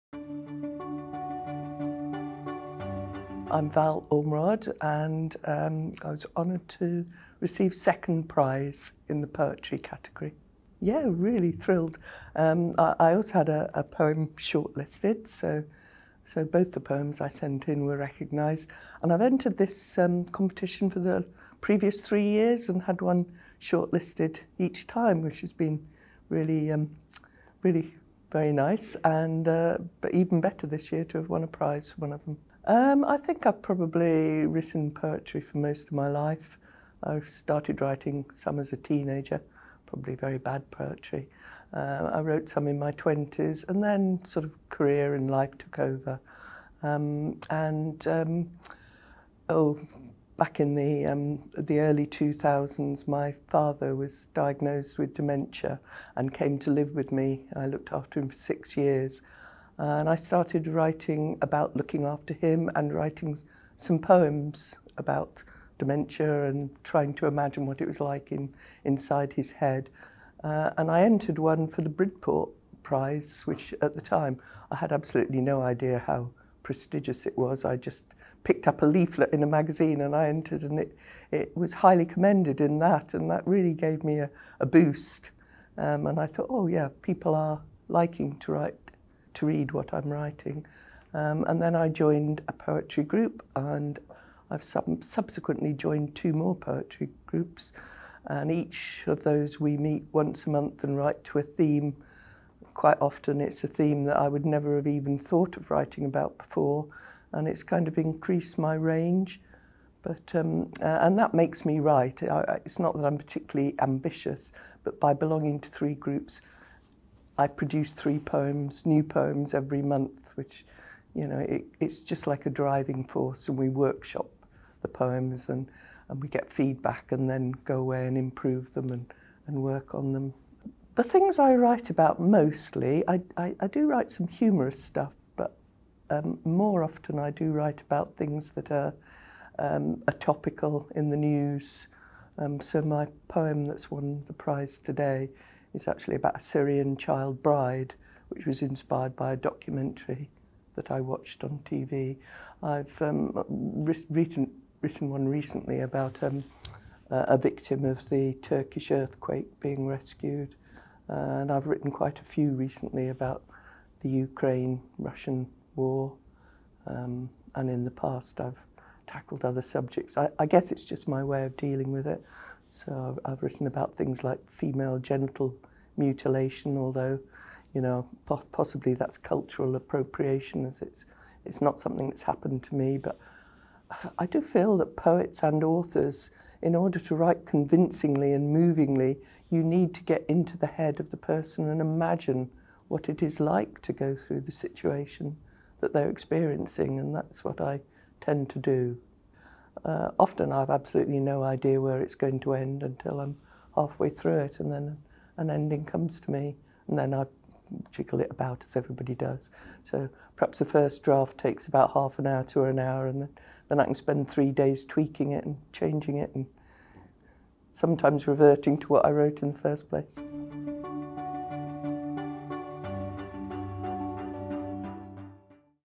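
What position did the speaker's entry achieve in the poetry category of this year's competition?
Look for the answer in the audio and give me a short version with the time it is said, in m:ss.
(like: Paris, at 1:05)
Second prize, at 0:07.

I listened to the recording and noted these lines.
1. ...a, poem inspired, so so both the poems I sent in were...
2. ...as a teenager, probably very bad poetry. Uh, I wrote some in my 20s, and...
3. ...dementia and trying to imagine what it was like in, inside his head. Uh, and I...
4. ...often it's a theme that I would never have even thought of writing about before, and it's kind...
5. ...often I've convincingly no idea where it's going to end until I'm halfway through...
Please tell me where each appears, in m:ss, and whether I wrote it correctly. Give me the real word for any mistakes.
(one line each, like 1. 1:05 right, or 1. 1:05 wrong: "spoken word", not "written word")
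1. 0:13 wrong: "shortlisted", not "inspired"
2. 0:38 right
3. 1:05 right
4. 1:43 right
5. 3:20 wrong: "absolutely", not "convincingly".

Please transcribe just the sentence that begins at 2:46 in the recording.
Um, and in the past, I've tackled other subjects.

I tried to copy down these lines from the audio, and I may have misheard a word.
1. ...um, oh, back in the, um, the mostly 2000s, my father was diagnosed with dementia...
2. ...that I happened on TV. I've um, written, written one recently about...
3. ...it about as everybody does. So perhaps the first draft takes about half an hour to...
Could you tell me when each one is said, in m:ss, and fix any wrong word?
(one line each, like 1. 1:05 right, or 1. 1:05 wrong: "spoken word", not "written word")
1. 0:48 wrong: "early", not "mostly"
2. 2:30 wrong: "watched", not "happened"
3. 3:28 right.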